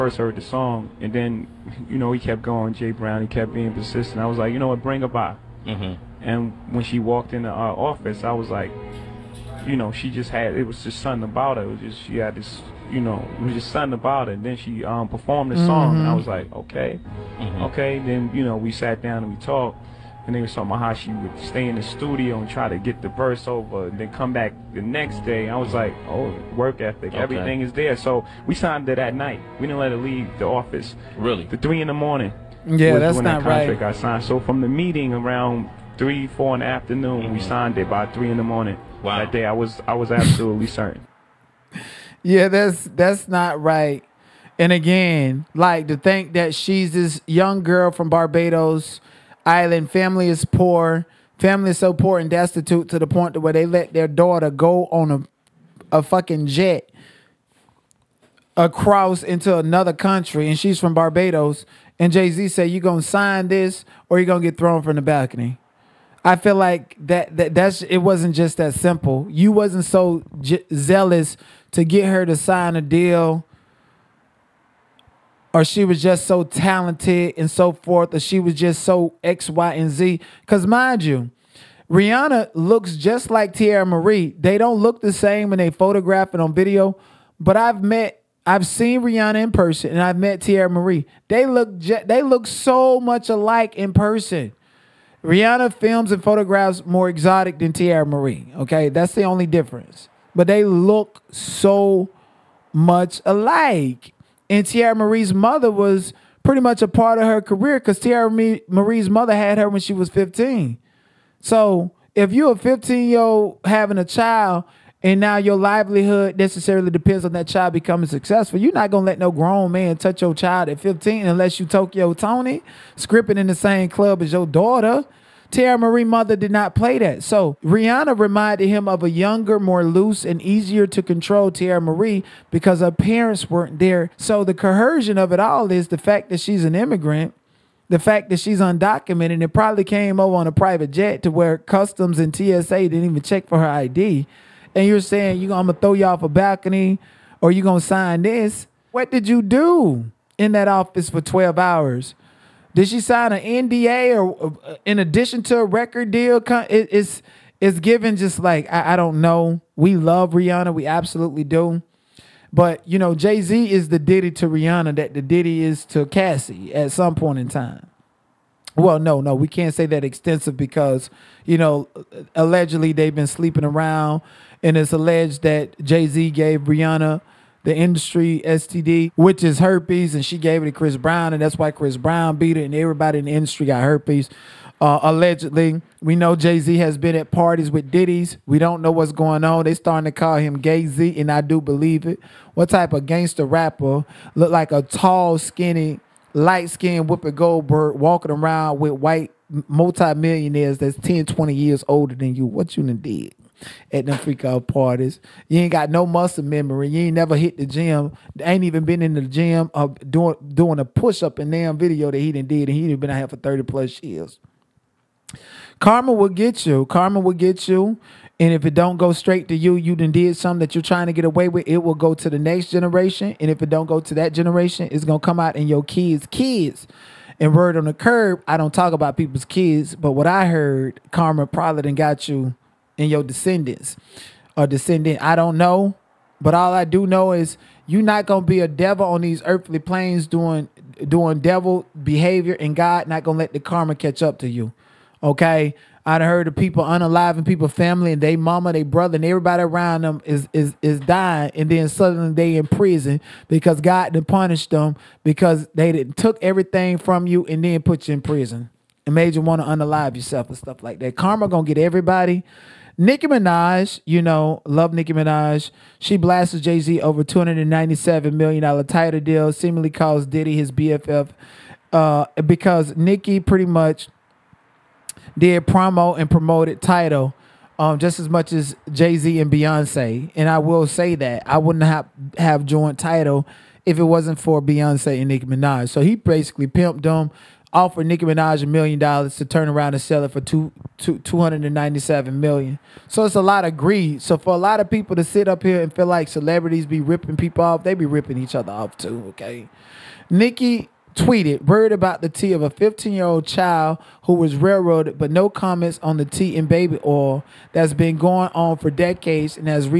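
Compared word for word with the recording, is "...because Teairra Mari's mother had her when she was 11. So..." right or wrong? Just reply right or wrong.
wrong.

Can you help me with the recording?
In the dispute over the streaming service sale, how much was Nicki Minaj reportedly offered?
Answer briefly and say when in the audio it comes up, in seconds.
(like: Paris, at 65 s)
$1 million, at 288 s.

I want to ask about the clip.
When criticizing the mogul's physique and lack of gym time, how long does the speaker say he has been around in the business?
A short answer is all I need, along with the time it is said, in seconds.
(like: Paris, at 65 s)
30 plus years, at 213 s.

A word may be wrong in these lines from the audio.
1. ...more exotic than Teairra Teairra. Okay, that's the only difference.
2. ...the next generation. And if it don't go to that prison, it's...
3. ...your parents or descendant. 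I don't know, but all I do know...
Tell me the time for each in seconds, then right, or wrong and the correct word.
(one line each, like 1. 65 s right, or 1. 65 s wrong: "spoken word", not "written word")
1. 96 s wrong: "Mari", not "Teairra"
2. 222 s wrong: "generation", not "prison"
3. 233 s wrong: "descendants", not "parents".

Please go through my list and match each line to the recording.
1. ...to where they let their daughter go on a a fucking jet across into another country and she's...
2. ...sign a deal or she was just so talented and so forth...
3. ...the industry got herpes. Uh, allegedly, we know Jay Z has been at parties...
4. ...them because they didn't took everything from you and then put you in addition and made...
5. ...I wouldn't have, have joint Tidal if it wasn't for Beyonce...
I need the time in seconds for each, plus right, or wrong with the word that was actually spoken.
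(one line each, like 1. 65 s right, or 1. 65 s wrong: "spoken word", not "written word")
1. 53 s right
2. 72 s right
3. 183 s right
4. 254 s wrong: "prison", not "addition"
5. 281 s right.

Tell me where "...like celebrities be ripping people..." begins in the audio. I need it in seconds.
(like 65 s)
296 s.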